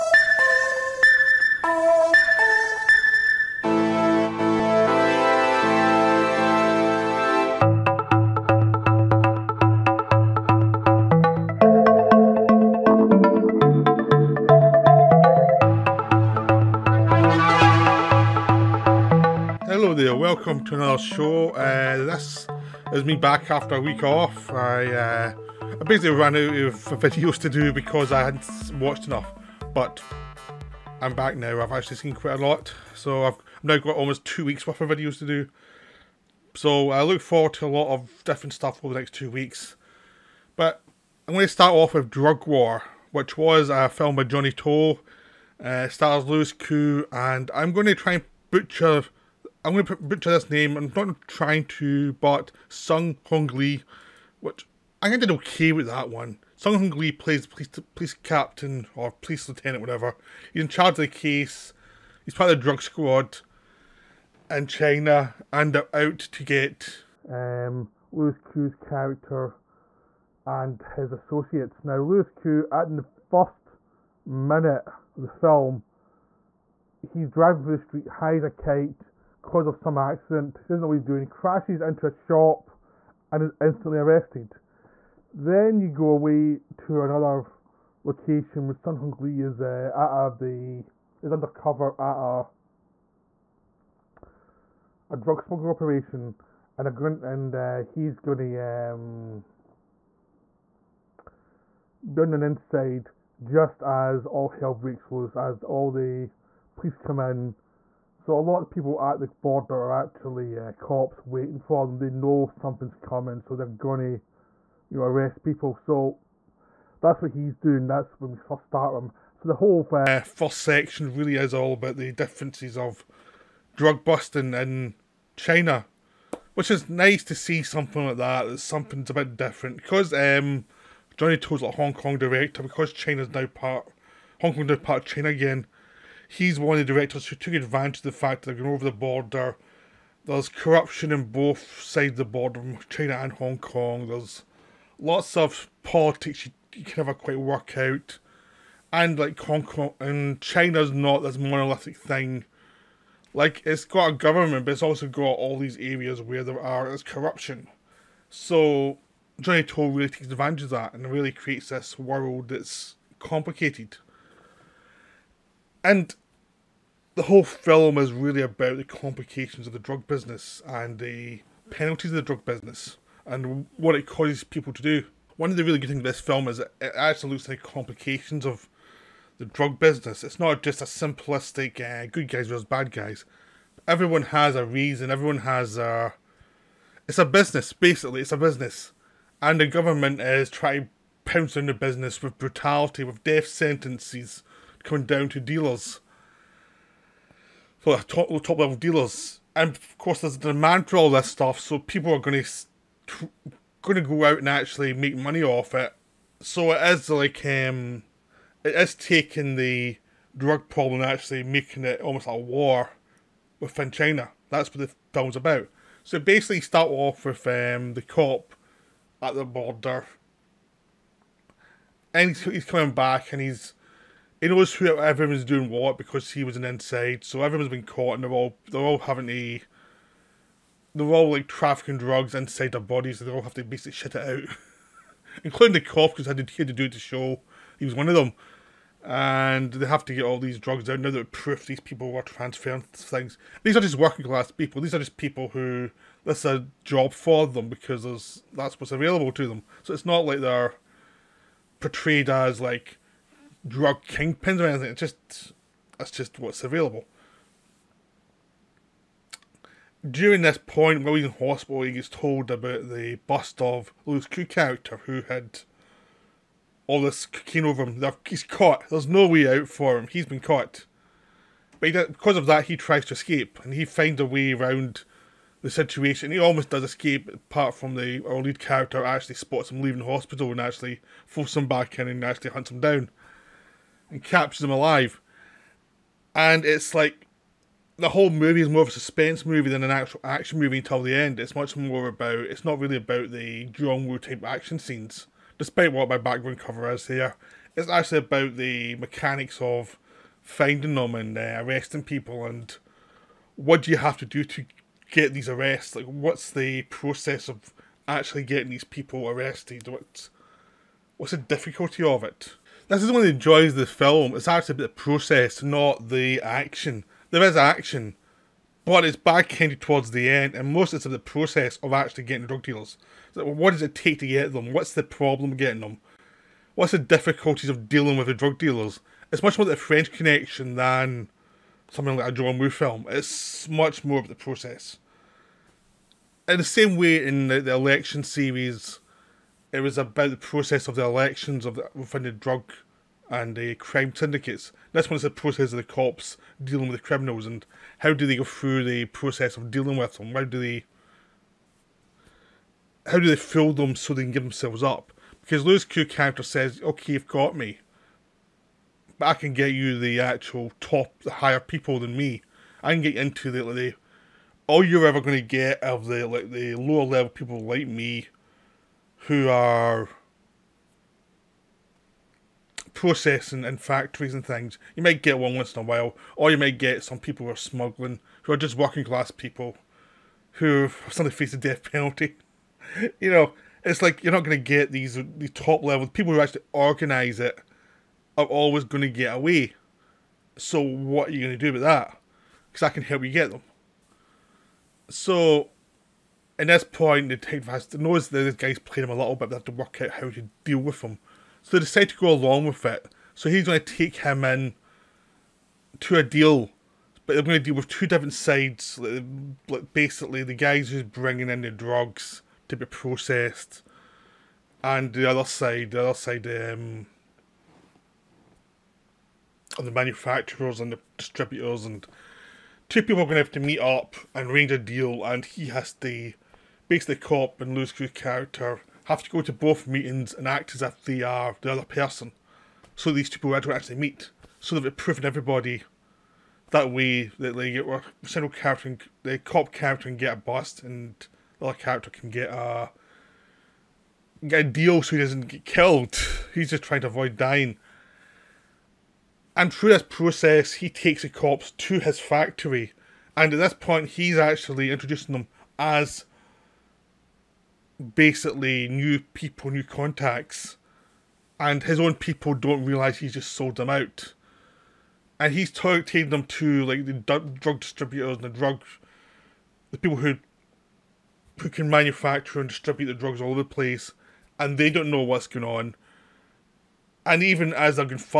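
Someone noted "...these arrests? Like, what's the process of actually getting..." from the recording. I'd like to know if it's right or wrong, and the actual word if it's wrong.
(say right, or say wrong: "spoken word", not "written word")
right.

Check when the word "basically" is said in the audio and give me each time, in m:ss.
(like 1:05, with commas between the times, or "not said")
0:25, 3:07, 3:36, 3:53, 6:49, 7:06, 7:38.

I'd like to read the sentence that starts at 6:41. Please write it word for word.
So they decide to go along with it.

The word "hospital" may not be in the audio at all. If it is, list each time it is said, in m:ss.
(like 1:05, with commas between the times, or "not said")
4:21, 4:40.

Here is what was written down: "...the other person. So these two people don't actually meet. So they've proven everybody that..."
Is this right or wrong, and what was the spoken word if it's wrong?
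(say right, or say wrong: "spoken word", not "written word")
right.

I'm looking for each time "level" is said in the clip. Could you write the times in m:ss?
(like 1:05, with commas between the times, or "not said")
3:18, 6:07, 6:25.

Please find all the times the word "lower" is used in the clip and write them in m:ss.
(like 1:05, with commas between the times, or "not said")
6:06.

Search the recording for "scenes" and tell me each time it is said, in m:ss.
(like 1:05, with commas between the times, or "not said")
4:54.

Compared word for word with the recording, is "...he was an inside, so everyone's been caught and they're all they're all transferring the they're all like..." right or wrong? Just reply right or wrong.
wrong.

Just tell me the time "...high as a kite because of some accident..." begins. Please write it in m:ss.
1:18.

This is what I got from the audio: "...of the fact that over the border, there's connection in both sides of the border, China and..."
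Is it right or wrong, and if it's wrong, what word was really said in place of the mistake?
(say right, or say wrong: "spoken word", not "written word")
wrong: "corruption", not "connection".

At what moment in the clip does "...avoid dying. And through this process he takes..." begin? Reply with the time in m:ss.
7:27.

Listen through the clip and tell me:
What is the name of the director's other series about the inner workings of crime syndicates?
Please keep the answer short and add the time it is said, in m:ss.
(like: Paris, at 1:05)
Election, at 5:37.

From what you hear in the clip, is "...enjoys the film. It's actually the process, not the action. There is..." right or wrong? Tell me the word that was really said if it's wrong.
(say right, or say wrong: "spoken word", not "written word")
right.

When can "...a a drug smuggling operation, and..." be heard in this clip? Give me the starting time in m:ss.
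1:34.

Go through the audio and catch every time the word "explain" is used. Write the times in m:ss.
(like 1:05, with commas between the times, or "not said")
not said.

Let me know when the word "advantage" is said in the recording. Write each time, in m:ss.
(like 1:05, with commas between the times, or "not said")
2:17, 2:40.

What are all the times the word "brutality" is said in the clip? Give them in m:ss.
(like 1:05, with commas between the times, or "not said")
3:12.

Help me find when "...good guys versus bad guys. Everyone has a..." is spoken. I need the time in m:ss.
3:02.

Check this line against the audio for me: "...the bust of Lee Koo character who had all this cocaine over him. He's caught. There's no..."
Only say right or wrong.
wrong.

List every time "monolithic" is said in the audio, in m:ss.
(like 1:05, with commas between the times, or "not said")
2:31.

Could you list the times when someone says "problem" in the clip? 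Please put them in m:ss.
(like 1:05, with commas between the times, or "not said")
3:30, 5:25.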